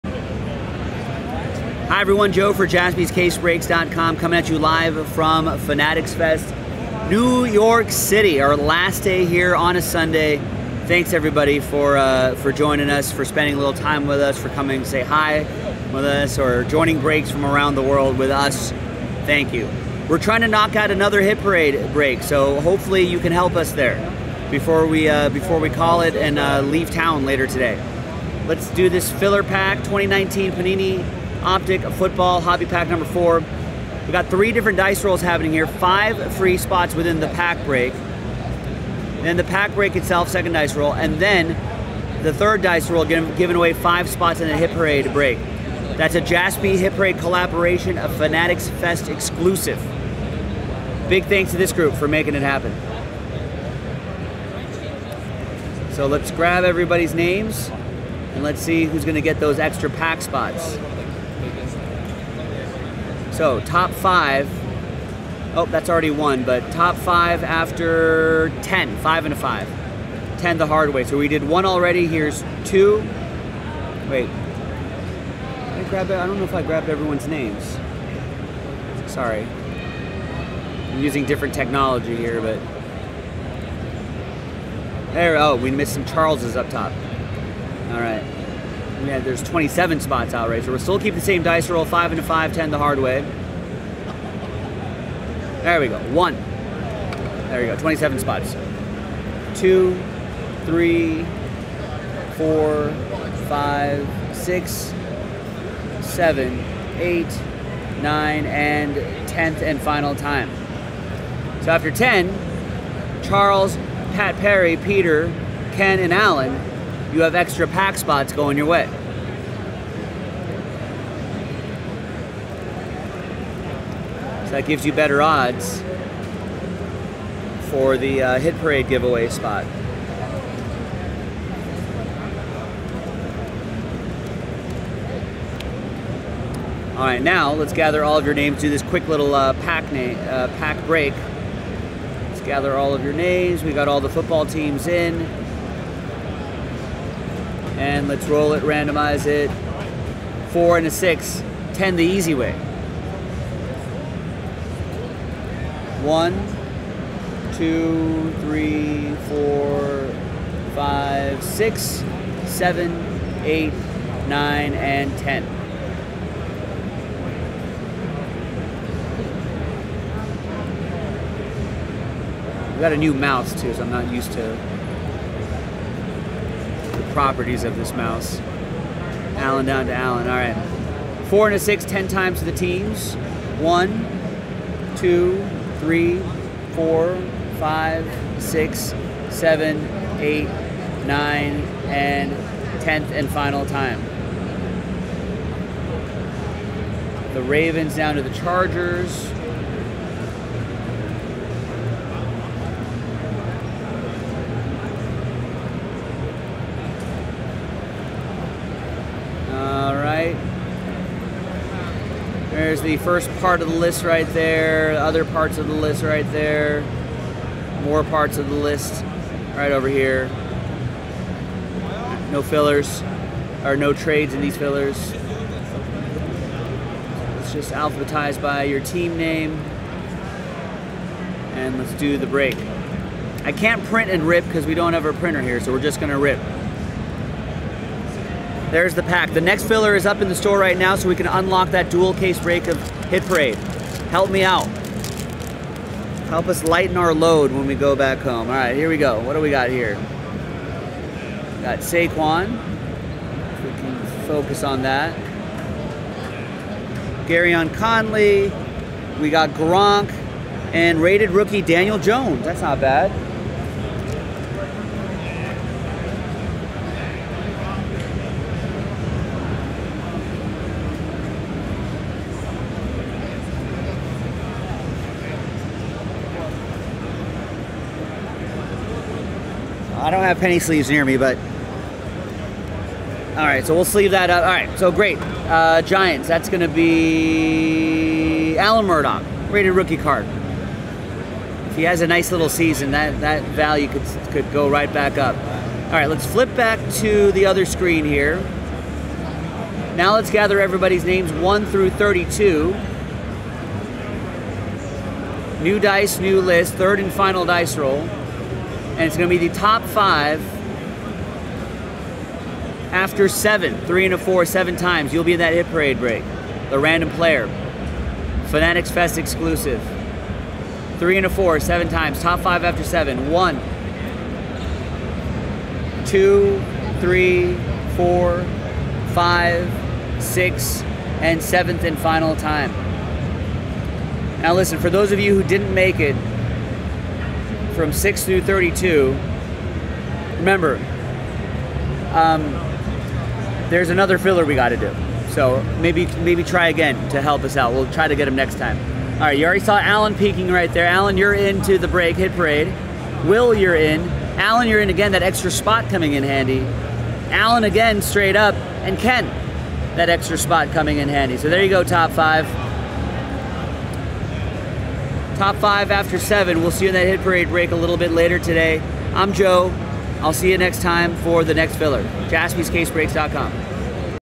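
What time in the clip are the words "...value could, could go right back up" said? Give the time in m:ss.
4:53.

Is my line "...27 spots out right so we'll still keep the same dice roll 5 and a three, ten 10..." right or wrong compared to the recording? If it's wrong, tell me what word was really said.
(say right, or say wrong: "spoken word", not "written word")
wrong: "five", not "three".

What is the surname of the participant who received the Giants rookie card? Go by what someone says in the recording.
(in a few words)
Murdoch.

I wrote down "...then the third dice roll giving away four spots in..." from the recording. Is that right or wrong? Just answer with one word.
wrong.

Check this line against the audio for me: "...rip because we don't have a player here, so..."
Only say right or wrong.
wrong.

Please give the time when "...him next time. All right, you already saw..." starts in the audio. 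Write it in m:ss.
5:48.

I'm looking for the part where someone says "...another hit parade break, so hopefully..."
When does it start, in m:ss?
0:20.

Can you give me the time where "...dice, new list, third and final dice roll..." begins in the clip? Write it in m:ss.
5:05.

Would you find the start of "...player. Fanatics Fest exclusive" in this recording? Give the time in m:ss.
5:17.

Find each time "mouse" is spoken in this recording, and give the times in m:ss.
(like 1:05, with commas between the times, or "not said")
2:53, 2:57.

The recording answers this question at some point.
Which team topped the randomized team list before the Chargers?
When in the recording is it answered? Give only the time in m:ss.
3:17.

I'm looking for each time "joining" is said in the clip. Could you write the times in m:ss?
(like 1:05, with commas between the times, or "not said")
0:12, 0:16.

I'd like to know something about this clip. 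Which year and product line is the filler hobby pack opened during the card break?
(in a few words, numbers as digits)
2019 Panini Optic.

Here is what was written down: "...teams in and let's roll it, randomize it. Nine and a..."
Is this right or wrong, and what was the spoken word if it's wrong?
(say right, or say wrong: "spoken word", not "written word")
wrong: "Four", not "Nine".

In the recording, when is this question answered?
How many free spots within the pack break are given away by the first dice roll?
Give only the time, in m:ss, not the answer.
0:35.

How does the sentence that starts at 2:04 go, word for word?
So that gives you better odds for the uh, Hit Parade giveaway spot.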